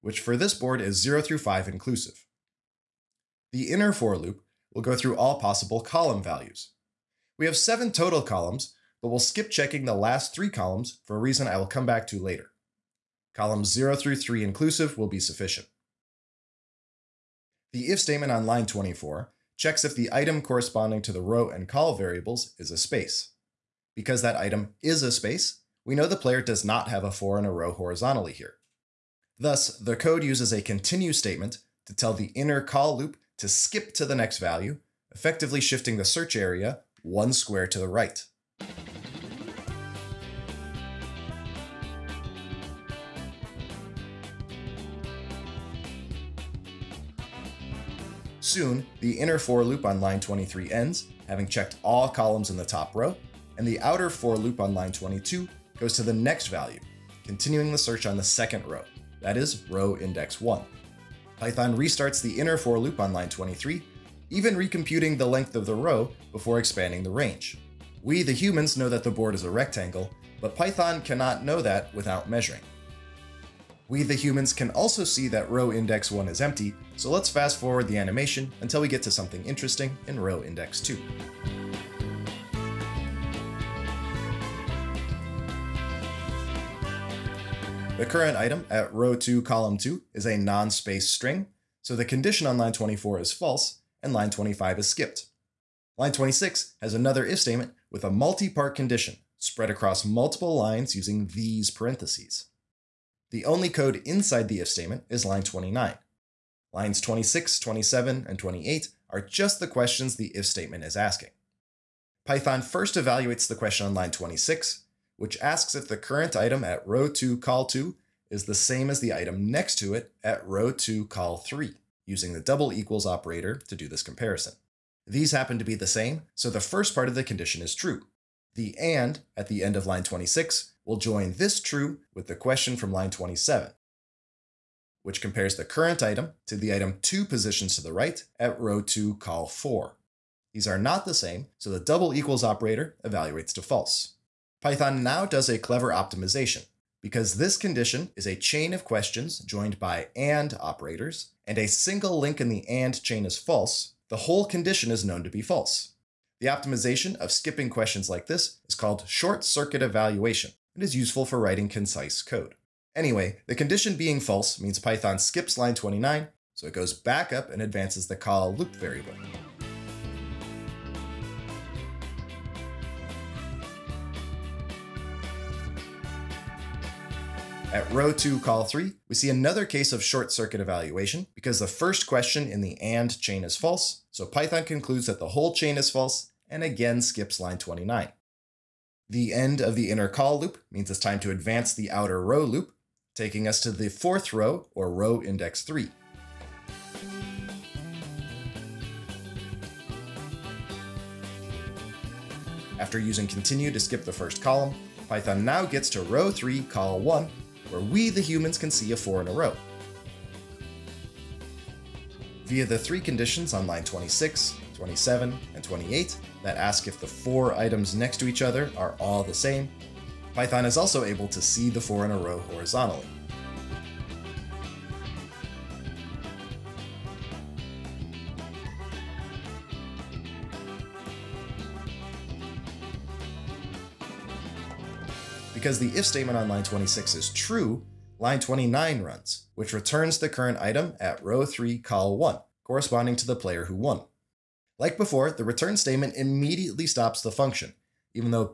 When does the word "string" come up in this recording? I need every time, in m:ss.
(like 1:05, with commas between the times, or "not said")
1:31.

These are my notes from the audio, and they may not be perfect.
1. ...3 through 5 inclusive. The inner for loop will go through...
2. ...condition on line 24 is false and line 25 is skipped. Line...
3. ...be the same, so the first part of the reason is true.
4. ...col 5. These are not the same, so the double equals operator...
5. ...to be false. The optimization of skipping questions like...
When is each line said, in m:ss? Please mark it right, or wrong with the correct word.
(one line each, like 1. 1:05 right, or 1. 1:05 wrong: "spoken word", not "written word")
1. 0:01 wrong: "0", not "3"
2. 1:32 right
3. 2:05 wrong: "condition", not "reason"
4. 2:19 wrong: "4", not "5"
5. 2:35 right.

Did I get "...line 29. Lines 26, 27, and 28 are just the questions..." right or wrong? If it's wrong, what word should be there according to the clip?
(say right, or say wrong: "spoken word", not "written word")
right.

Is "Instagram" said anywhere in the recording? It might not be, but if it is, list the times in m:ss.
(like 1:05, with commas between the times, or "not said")
not said.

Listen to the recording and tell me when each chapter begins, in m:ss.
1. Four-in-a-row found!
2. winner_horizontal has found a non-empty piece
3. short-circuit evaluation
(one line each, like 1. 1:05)
1. 3:25
2. 1:27
3. 2:23.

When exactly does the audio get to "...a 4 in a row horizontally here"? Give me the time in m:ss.
0:27.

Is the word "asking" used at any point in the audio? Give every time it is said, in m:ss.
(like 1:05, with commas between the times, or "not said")
1:50.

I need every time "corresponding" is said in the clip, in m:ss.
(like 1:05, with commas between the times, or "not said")
0:20, 4:02.